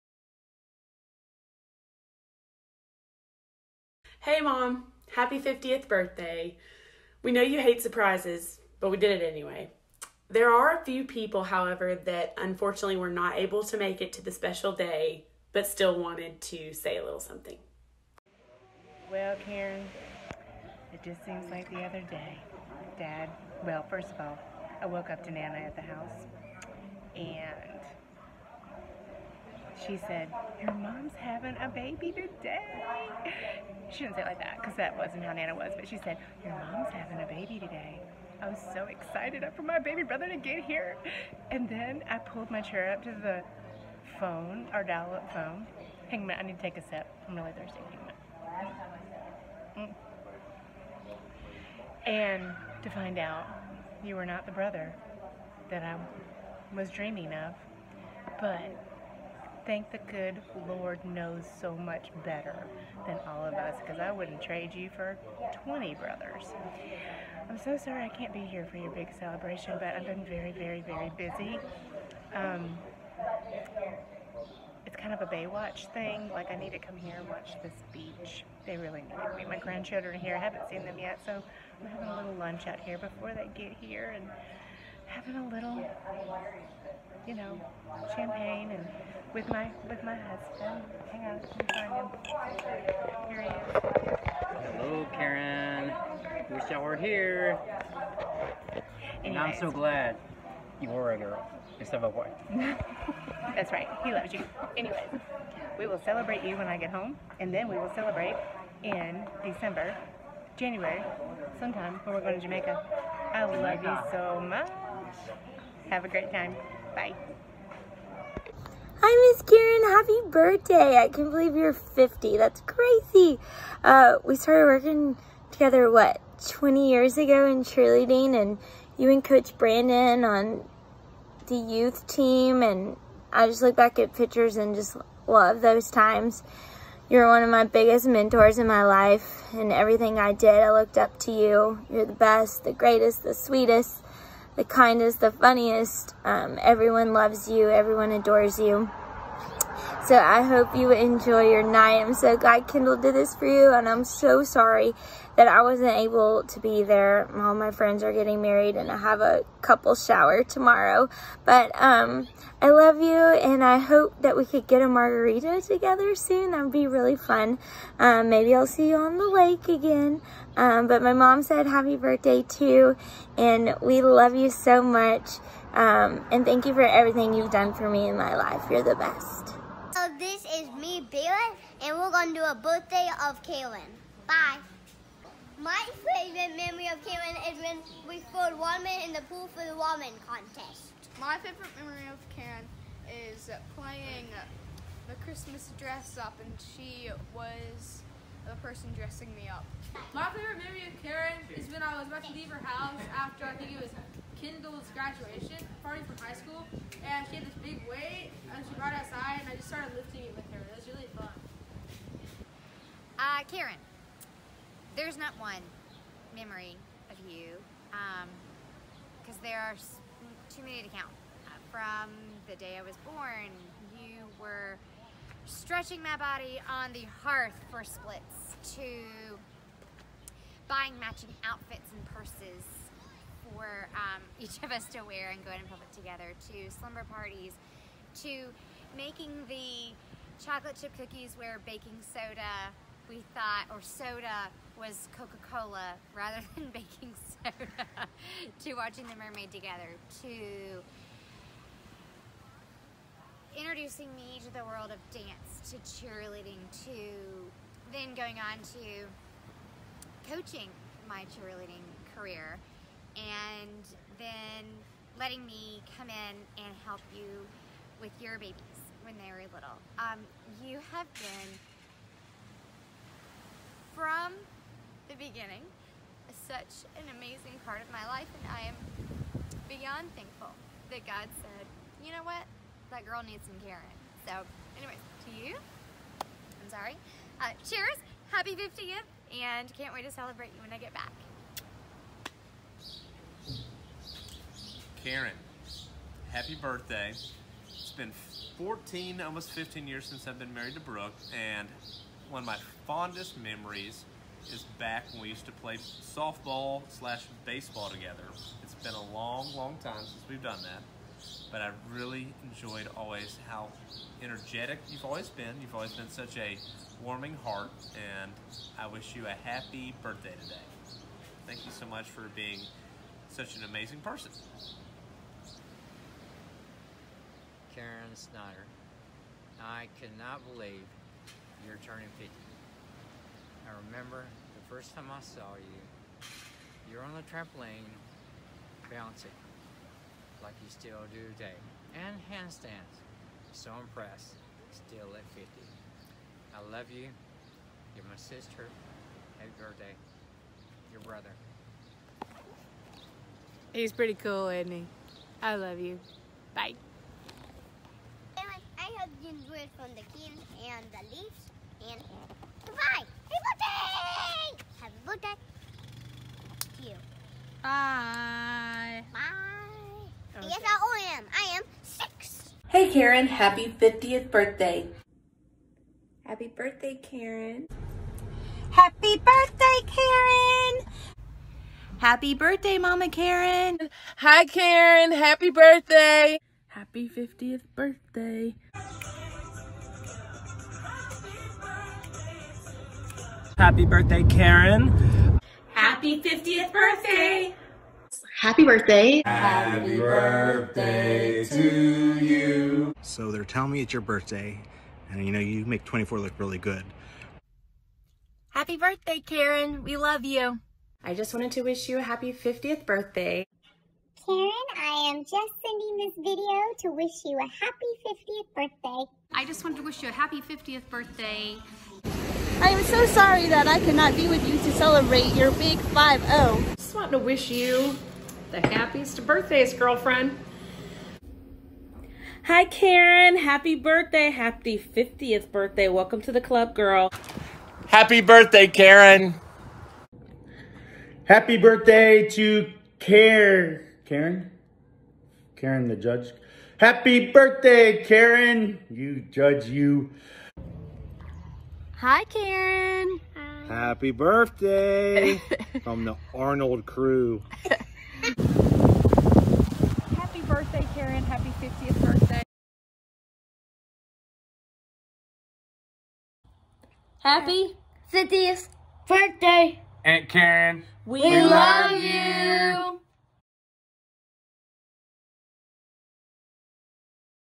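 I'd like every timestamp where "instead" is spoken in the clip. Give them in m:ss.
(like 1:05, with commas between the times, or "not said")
1:41.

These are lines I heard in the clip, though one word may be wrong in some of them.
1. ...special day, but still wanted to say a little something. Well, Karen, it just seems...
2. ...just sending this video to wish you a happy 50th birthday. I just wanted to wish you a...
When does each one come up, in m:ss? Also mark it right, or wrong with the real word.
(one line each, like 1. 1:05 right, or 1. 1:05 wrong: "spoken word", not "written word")
1. 0:14 right
2. 6:55 right.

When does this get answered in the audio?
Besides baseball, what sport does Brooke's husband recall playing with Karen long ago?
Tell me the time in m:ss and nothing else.
5:05.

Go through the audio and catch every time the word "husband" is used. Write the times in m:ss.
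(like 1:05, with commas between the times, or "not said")
1:30.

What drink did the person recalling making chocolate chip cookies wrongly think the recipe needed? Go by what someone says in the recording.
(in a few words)
Coca-Cola.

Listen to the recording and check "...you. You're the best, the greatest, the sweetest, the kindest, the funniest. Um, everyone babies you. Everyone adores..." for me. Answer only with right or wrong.
wrong.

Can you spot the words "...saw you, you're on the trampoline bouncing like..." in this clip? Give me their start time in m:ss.
5:35.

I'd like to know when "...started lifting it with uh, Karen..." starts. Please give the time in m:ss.
3:29.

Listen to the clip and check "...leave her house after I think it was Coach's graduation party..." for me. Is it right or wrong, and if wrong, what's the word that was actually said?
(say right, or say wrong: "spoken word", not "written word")
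wrong: "Kendall", not "Coach".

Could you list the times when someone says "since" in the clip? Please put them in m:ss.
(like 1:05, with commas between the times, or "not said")
5:00, 5:09.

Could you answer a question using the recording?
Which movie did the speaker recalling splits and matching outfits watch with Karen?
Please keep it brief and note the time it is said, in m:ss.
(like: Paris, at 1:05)
The Mermaid, at 4:09.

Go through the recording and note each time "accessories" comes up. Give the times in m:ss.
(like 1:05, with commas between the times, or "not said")
not said.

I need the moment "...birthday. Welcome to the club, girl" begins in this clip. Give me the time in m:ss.
7:15.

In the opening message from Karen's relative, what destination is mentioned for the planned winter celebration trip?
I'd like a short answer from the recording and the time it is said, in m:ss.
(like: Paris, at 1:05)
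Jamaica, at 1:52.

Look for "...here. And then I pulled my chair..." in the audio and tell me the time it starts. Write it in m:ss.
0:40.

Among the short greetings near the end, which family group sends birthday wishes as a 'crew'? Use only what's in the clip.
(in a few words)
the Arnold crew.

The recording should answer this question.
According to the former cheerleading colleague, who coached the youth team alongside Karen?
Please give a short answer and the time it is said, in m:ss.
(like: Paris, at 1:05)
Coach Brandon, at 2:09.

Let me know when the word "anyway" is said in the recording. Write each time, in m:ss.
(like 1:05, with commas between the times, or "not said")
0:09, 1:44, 4:44.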